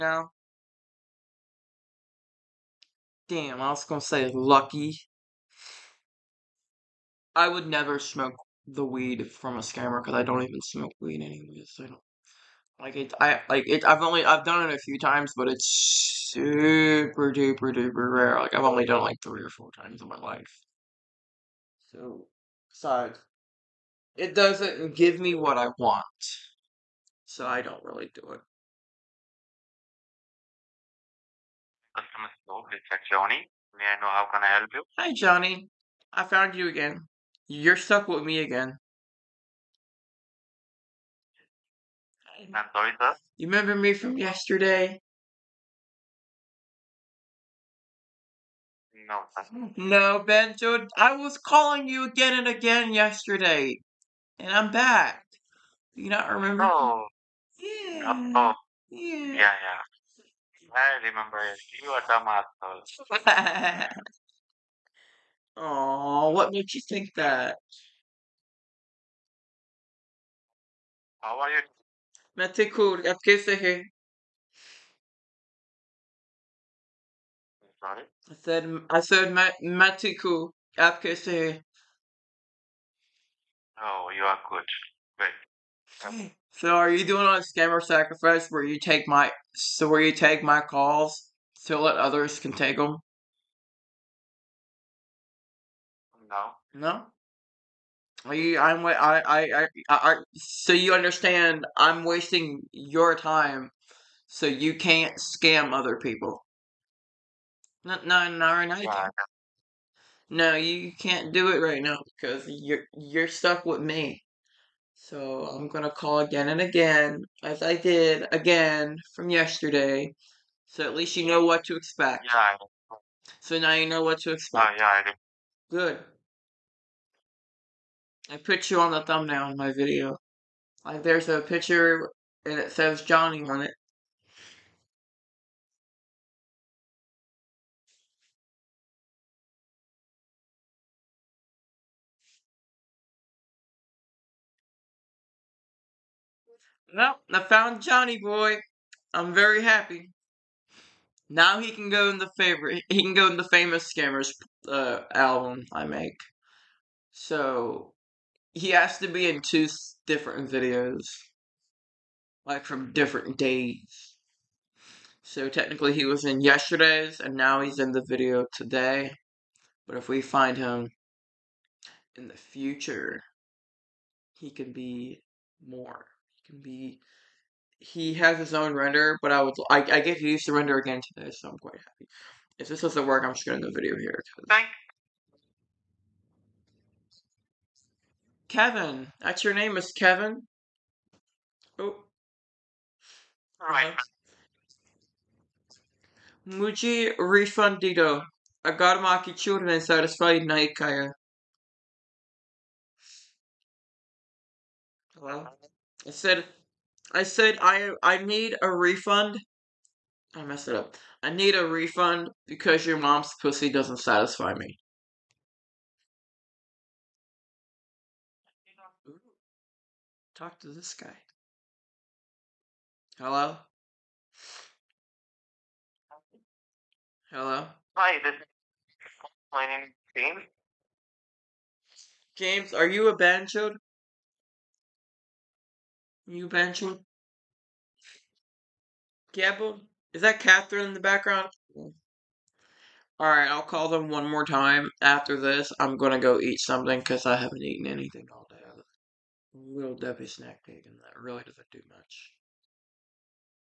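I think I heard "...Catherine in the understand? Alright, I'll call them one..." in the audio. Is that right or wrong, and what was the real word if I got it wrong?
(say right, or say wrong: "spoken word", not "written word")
wrong: "background", not "understand".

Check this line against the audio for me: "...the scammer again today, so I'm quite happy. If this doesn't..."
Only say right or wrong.
wrong.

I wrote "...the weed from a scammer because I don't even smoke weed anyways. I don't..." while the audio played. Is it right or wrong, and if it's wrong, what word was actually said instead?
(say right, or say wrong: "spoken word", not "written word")
right.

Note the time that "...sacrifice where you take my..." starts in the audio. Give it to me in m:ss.
1:27.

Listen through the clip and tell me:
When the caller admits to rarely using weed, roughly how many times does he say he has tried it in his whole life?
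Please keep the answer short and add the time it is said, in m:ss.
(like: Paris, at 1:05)
3 or 4, at 0:19.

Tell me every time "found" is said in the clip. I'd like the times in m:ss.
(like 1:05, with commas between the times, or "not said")
0:36, 2:27.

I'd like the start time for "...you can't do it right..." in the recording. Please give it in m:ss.
1:50.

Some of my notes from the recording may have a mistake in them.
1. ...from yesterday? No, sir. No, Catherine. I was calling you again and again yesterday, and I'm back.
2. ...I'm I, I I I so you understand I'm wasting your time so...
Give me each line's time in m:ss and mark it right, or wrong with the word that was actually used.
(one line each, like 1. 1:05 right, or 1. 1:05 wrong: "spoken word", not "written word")
1. 0:43 wrong: "Benjo", not "Catherine"
2. 1:38 right.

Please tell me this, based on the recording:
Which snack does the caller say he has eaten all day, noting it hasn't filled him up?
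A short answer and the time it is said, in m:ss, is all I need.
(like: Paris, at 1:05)
Little Debbie snack cake, at 4:09.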